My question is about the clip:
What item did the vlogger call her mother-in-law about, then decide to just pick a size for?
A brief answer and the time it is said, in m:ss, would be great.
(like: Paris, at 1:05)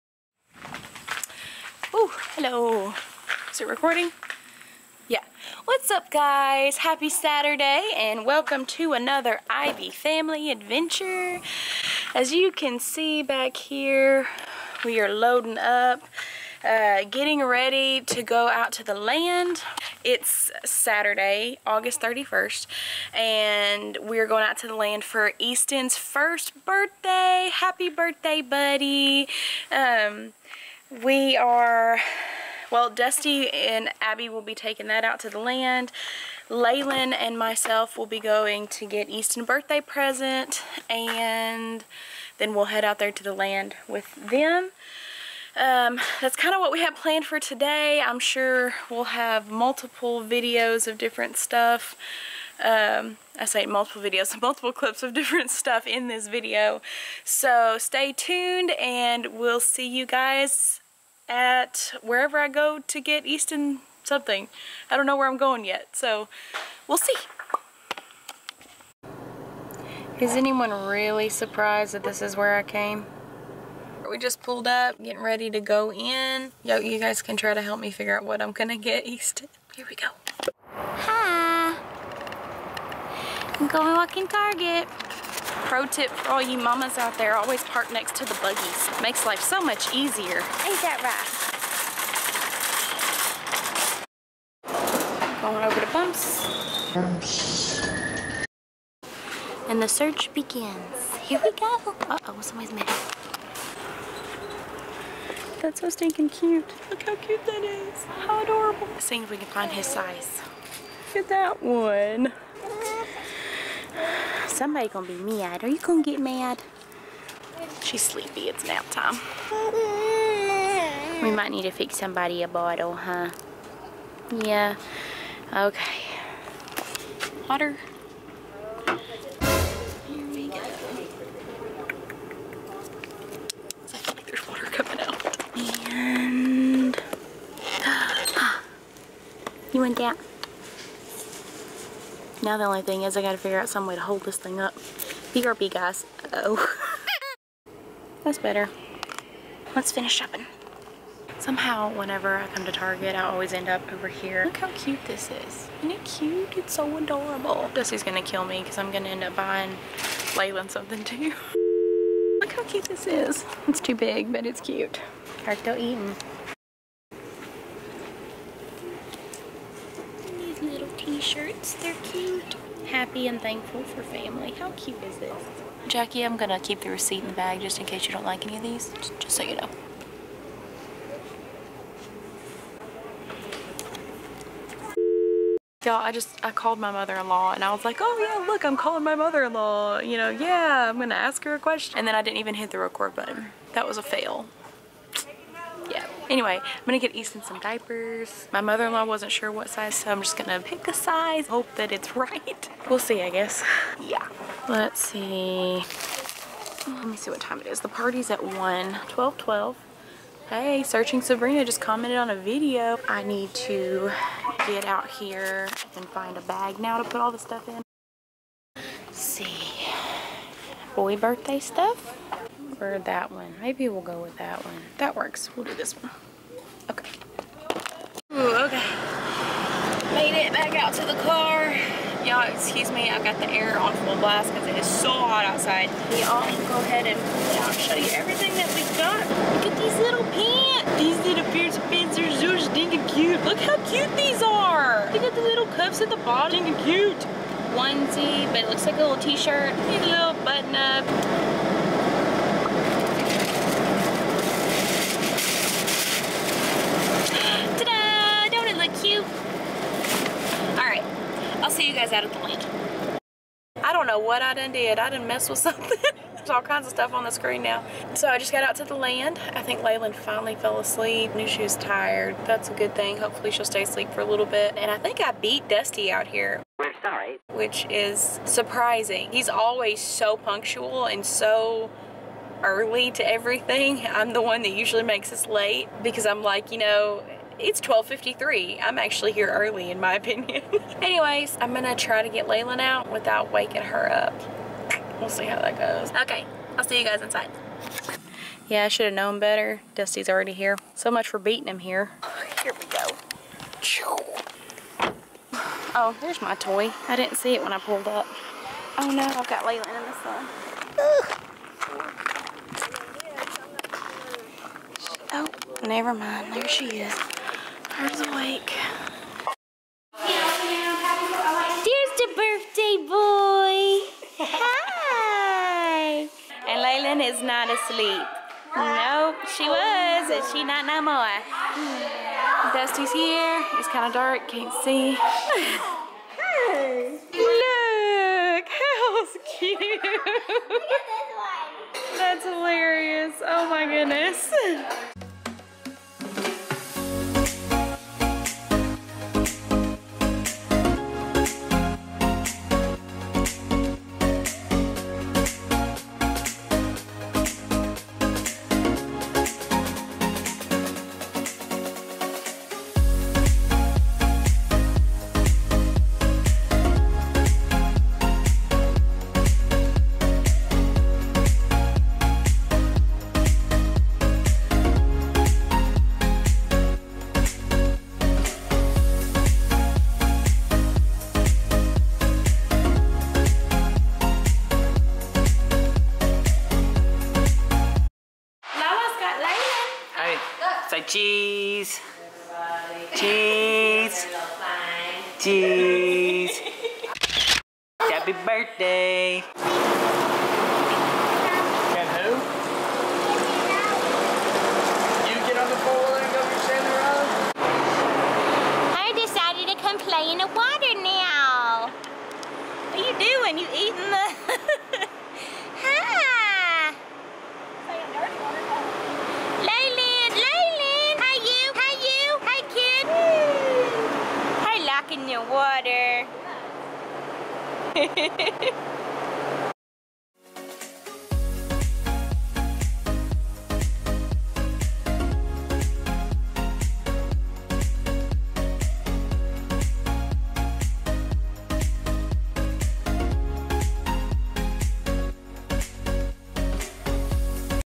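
diapers, at 3:17.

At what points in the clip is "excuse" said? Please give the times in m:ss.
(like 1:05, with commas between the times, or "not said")
3:52.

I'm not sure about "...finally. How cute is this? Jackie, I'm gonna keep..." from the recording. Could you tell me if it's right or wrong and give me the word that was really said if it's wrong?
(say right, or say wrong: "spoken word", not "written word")
wrong: "family", not "finally".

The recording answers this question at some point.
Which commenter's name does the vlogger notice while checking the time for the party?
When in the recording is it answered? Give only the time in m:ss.
3:30.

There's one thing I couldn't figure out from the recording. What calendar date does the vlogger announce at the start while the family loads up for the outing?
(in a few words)
August 31st.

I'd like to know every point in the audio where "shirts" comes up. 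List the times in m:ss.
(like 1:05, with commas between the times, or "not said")
2:51, 4:09.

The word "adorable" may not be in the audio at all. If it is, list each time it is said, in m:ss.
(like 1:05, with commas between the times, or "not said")
1:48, 2:36.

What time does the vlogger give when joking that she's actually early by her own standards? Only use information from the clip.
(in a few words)
12:53.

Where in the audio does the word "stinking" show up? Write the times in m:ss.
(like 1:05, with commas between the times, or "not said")
1:45, 4:02, 4:06.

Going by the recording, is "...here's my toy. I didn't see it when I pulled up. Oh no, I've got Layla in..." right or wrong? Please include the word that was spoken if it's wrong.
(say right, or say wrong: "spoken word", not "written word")
right.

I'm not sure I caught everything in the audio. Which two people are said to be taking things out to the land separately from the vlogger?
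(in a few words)
Dusty and Abbie.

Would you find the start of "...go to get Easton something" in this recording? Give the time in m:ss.
1:02.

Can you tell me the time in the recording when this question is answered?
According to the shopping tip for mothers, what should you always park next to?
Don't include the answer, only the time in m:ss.
1:28.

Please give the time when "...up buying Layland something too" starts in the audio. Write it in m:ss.
2:39.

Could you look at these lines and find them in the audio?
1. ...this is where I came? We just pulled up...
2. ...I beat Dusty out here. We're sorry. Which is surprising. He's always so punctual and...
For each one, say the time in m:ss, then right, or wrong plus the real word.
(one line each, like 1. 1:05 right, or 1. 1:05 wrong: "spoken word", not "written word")
1. 1:12 right
2. 4:35 right.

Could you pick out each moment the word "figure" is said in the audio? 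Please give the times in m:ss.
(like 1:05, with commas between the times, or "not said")
1:17, 2:23.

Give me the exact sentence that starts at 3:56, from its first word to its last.
Y'all, go ahead and I'll show you everything that we got.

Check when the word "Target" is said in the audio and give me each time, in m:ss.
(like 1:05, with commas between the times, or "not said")
1:24, 2:32.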